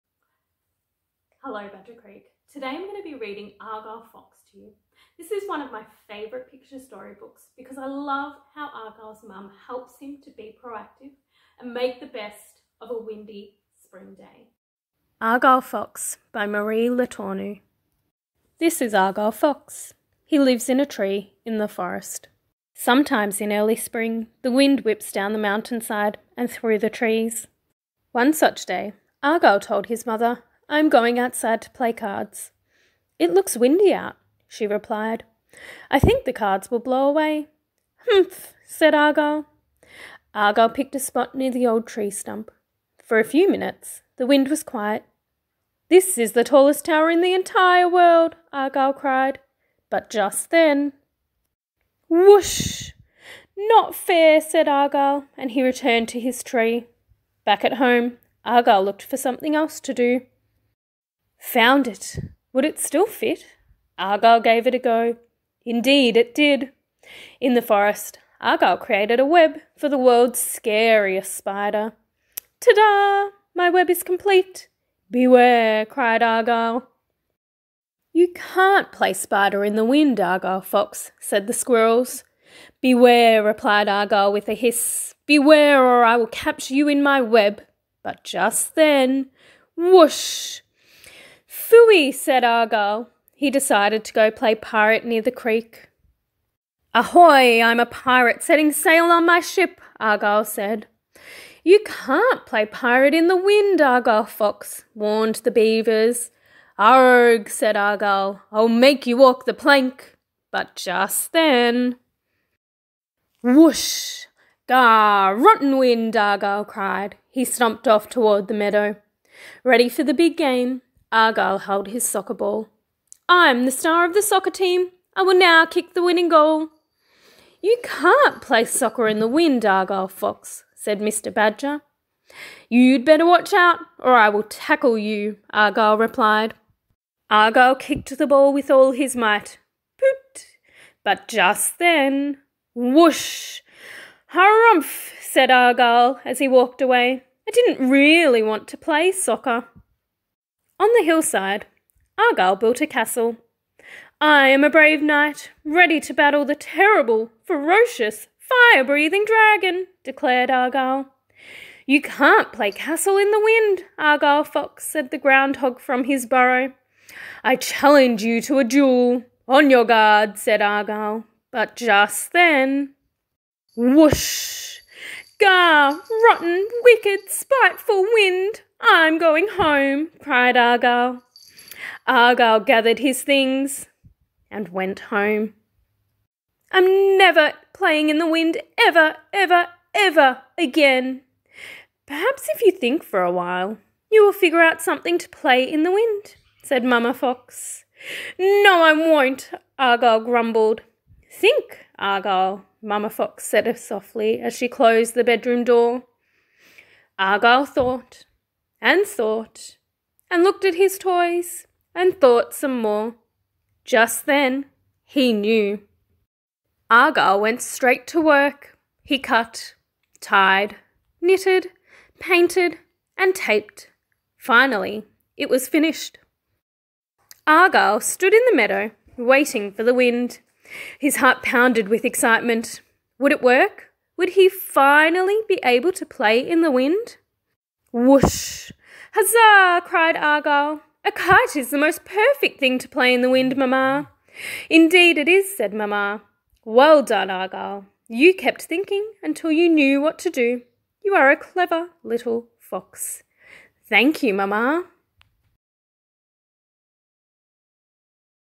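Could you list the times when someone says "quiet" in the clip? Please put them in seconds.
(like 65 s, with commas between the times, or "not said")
44 s.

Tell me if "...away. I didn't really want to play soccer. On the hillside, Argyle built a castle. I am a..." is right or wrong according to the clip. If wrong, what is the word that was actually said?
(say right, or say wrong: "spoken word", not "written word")
right.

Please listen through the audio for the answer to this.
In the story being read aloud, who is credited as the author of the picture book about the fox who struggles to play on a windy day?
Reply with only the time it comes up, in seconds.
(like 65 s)
16 s.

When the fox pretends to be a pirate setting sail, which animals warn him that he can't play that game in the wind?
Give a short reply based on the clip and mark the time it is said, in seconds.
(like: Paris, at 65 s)
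the beavers, at 105 s.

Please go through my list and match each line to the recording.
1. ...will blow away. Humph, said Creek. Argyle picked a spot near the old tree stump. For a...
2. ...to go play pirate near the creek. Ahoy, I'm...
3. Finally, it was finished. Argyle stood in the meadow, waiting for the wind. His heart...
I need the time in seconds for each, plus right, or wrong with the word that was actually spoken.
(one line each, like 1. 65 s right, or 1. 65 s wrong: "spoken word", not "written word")
1. 36 s wrong: "Argyle", not "Creek"
2. 94 s right
3. 224 s right.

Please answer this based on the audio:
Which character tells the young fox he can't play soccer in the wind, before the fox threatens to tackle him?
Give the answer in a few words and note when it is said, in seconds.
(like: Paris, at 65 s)
Mr. Badger, at 130 s.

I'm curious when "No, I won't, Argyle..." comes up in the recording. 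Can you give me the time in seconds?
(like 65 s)
198 s.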